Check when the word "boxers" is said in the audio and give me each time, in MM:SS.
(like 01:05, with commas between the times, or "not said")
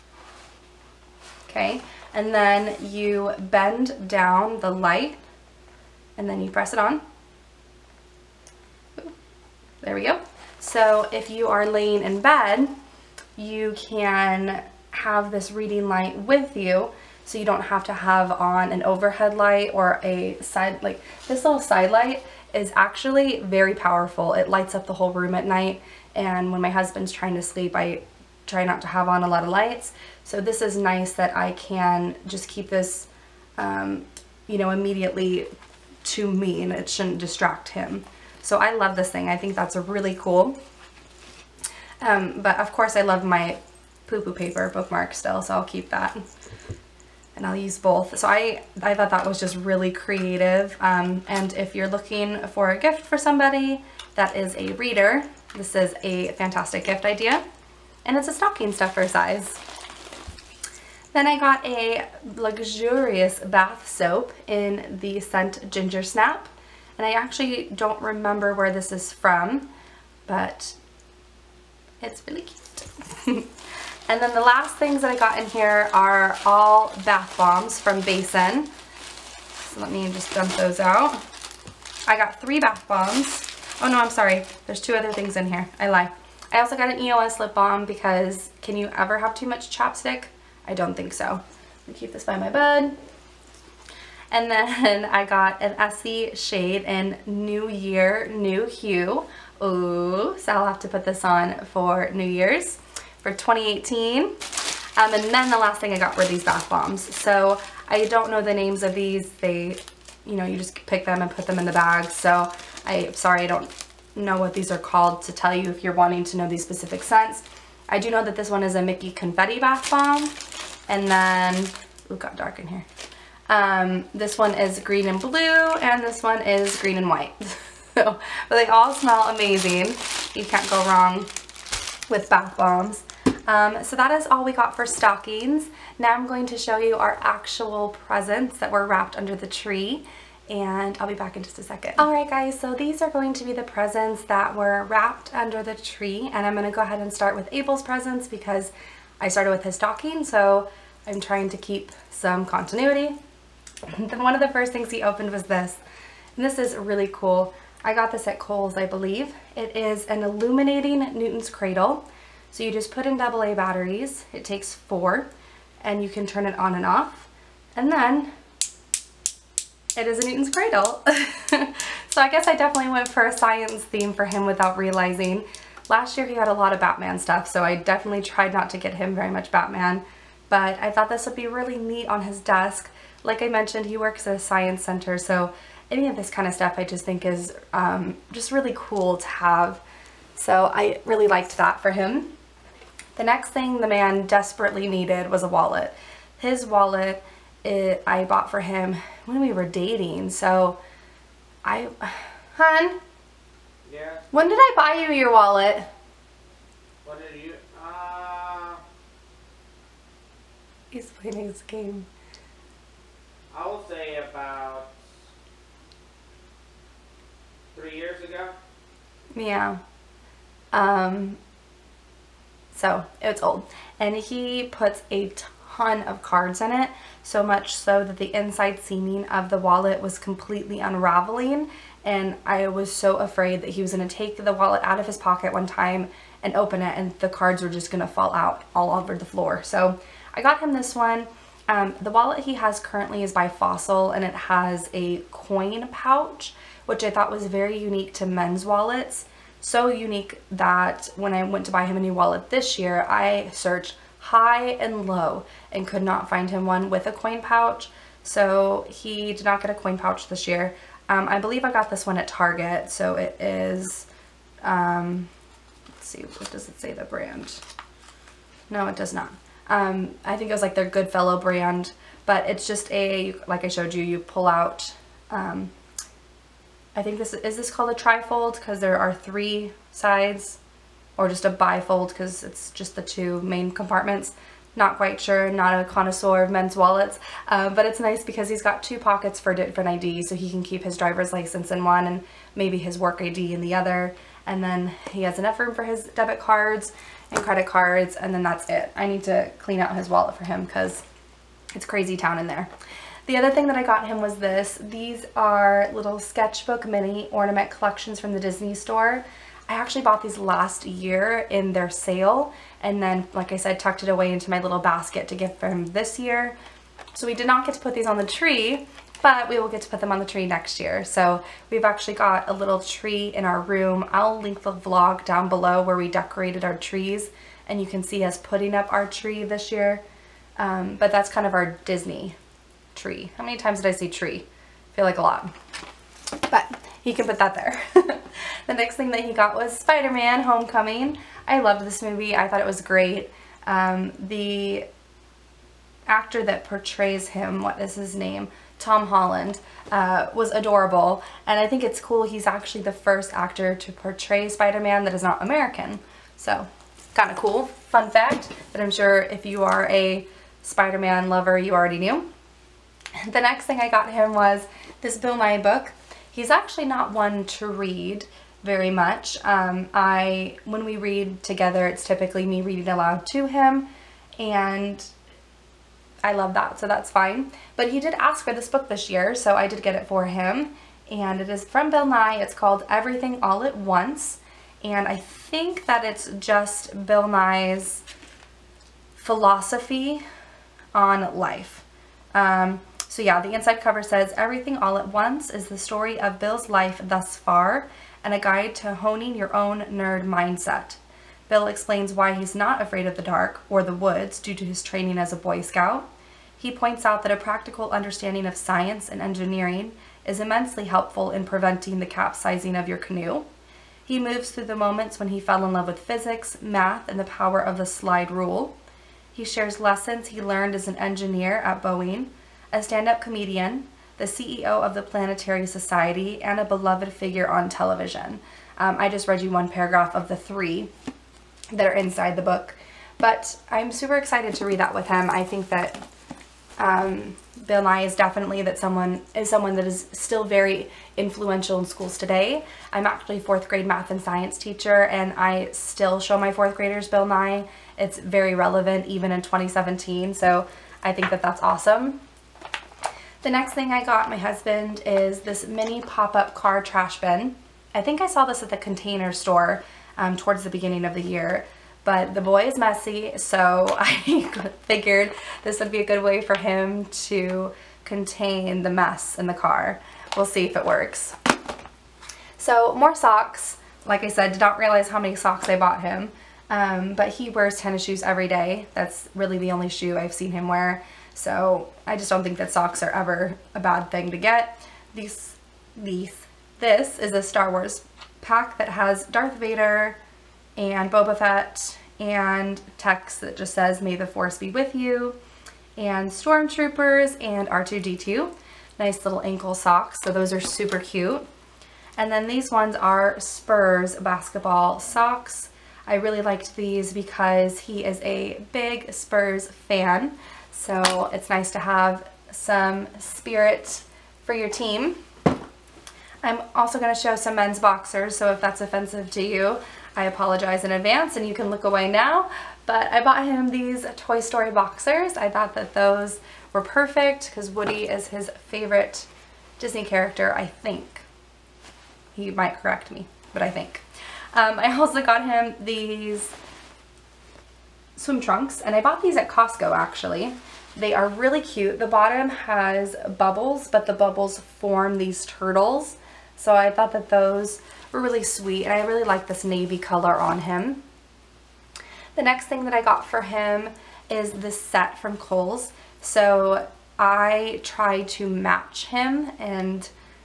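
08:37, 08:44.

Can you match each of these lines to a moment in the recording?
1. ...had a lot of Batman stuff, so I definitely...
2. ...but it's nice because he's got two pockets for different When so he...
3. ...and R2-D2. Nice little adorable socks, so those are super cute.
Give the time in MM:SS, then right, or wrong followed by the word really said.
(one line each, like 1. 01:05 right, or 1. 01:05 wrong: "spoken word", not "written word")
1. 02:56 right
2. 04:47 wrong: "IDs", not "When"
3. 08:17 wrong: "ankle", not "adorable".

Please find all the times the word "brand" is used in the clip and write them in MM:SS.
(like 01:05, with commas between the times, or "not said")
04:27, 04:31.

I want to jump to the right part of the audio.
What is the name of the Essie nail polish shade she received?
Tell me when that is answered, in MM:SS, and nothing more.
01:37.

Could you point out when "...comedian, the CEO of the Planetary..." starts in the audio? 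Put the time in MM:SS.
07:03.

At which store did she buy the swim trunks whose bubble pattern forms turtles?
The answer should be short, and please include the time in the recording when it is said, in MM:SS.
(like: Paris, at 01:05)
Costco, at 08:59.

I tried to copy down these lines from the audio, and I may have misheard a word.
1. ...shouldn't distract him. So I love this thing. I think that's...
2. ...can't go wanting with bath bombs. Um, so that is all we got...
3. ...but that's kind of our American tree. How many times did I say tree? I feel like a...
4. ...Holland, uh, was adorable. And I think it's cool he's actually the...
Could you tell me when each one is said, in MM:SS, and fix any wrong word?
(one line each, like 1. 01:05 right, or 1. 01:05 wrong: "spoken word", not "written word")
1. 00:36 right
2. 02:10 wrong: "wrong", not "wanting"
3. 05:30 wrong: "Disney", not "American"
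4. 05:49 right.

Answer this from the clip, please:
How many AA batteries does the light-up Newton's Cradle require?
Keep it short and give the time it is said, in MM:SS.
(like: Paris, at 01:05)
4, at 02:44.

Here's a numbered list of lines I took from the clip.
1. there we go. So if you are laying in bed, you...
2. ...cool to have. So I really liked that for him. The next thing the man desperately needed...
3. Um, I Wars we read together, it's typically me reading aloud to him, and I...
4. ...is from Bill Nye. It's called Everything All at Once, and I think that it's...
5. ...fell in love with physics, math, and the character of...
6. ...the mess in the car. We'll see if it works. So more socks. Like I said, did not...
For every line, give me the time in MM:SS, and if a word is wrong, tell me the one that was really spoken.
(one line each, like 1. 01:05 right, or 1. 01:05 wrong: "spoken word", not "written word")
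1. 00:09 right
2. 03:08 right
3. 06:09 wrong: "When", not "Wars"
4. 06:21 right
5. 06:55 wrong: "power", not "character"
6. 07:48 right.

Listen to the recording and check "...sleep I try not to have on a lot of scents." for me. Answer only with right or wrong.
wrong.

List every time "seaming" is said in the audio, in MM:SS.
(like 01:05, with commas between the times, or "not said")
03:48.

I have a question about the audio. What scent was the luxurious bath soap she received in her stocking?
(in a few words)
Ginger Snap.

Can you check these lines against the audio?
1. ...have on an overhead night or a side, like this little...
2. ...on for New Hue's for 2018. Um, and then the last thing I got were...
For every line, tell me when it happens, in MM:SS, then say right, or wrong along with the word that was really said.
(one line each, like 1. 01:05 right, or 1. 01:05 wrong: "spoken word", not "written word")
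1. 00:17 wrong: "light", not "night"
2. 01:41 wrong: "Year", not "Hue".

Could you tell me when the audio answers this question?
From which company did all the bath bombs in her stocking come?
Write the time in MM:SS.
01:18.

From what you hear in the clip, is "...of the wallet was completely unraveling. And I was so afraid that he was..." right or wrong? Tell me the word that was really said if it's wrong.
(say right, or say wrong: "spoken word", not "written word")
right.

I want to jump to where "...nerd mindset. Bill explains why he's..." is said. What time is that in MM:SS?
06:39.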